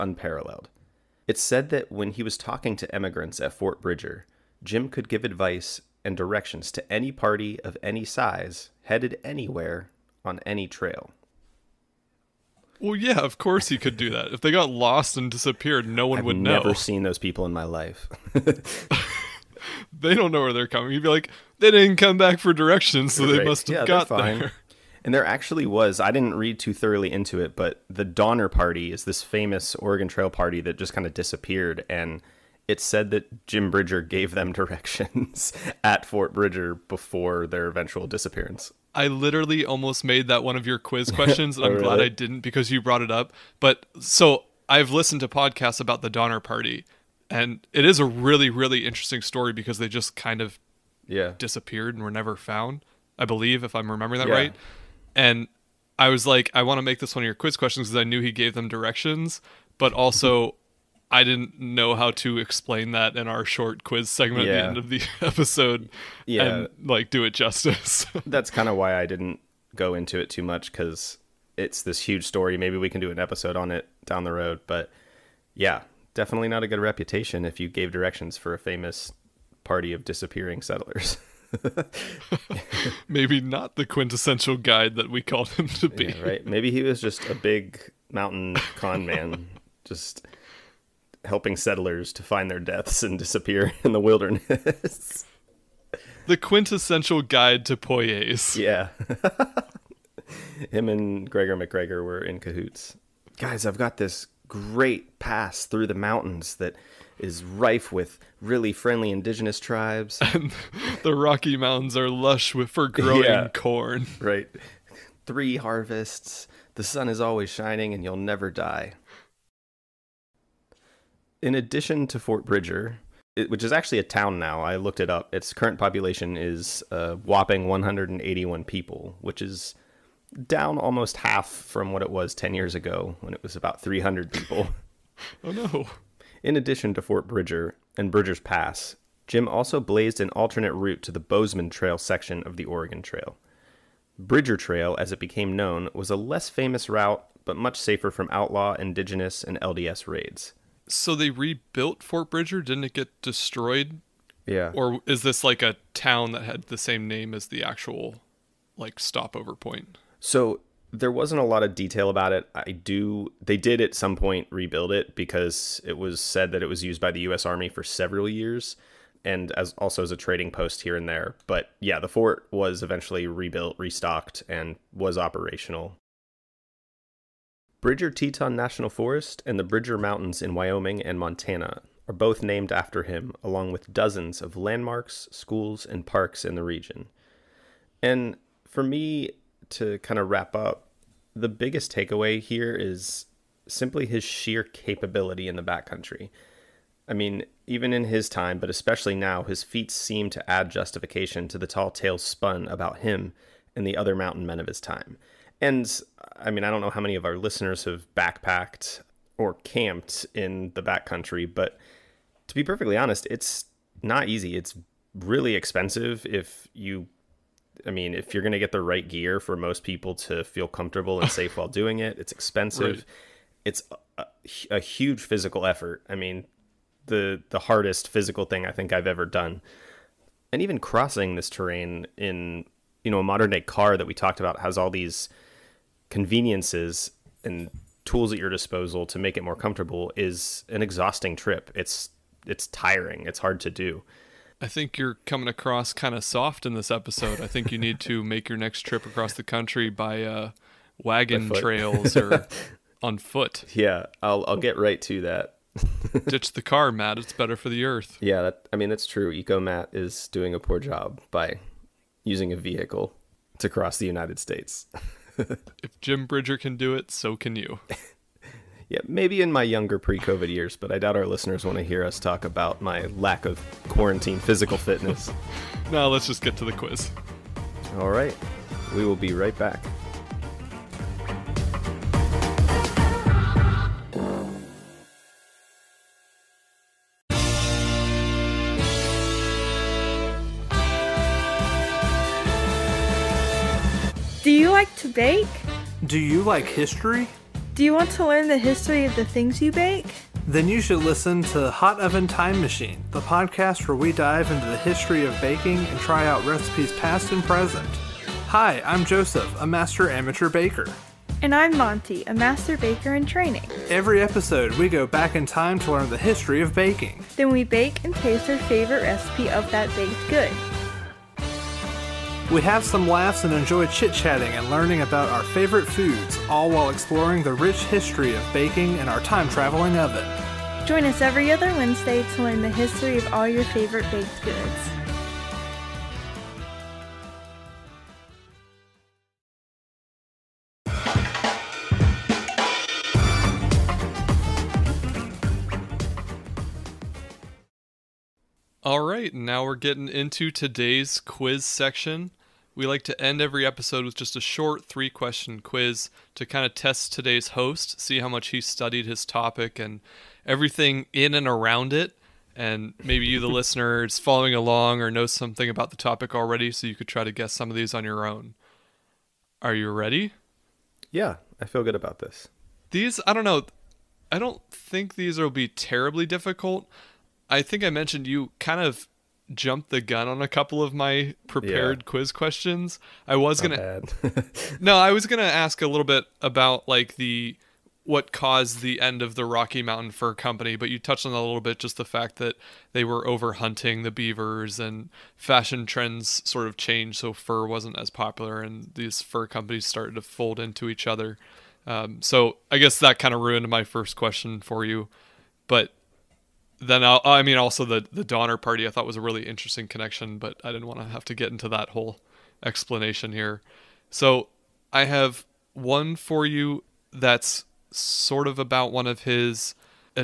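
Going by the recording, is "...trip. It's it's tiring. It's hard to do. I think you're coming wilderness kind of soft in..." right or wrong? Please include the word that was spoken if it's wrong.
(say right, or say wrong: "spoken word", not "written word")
wrong: "across", not "wilderness".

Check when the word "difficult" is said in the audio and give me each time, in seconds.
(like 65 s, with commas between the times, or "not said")
376 s.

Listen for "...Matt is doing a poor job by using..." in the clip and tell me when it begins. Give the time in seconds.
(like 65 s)
259 s.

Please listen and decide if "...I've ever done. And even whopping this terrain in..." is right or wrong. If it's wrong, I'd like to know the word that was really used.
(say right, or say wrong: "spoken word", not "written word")
wrong: "crossing", not "whopping".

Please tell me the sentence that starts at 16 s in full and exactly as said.
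I've never seen those people in my life.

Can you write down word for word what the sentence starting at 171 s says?
But yeah, the fort was eventually rebuilt, restocked and was operational.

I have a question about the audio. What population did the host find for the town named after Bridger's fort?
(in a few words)
181.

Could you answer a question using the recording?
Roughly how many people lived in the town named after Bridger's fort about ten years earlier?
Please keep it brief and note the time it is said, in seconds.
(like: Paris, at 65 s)
300, at 133 s.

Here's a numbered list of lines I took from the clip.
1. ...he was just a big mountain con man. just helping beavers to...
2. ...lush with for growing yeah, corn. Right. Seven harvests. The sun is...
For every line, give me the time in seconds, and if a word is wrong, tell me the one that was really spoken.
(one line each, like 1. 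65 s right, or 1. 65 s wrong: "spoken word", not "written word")
1. 86 s wrong: "settlers", not "beavers"
2. 112 s wrong: "Three", not "Seven".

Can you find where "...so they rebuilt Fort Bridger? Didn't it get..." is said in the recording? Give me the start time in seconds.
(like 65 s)
150 s.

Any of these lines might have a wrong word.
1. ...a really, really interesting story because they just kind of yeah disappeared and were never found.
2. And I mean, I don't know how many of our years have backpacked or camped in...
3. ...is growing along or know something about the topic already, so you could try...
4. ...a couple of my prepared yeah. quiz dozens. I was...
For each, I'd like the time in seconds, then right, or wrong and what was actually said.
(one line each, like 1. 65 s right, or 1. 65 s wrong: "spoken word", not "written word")
1. 47 s right
2. 205 s wrong: "listeners", not "years"
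3. 364 s wrong: "following", not "growing"
4. 380 s wrong: "questions", not "dozens".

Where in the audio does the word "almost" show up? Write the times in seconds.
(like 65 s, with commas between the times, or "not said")
39 s, 130 s.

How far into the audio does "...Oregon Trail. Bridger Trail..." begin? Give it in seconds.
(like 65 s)
142 s.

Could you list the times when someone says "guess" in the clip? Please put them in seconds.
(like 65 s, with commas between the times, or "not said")
367 s, 402 s.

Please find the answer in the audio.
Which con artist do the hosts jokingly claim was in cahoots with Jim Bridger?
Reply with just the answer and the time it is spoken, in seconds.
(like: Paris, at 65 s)
Gregor MacGregor, at 101 s.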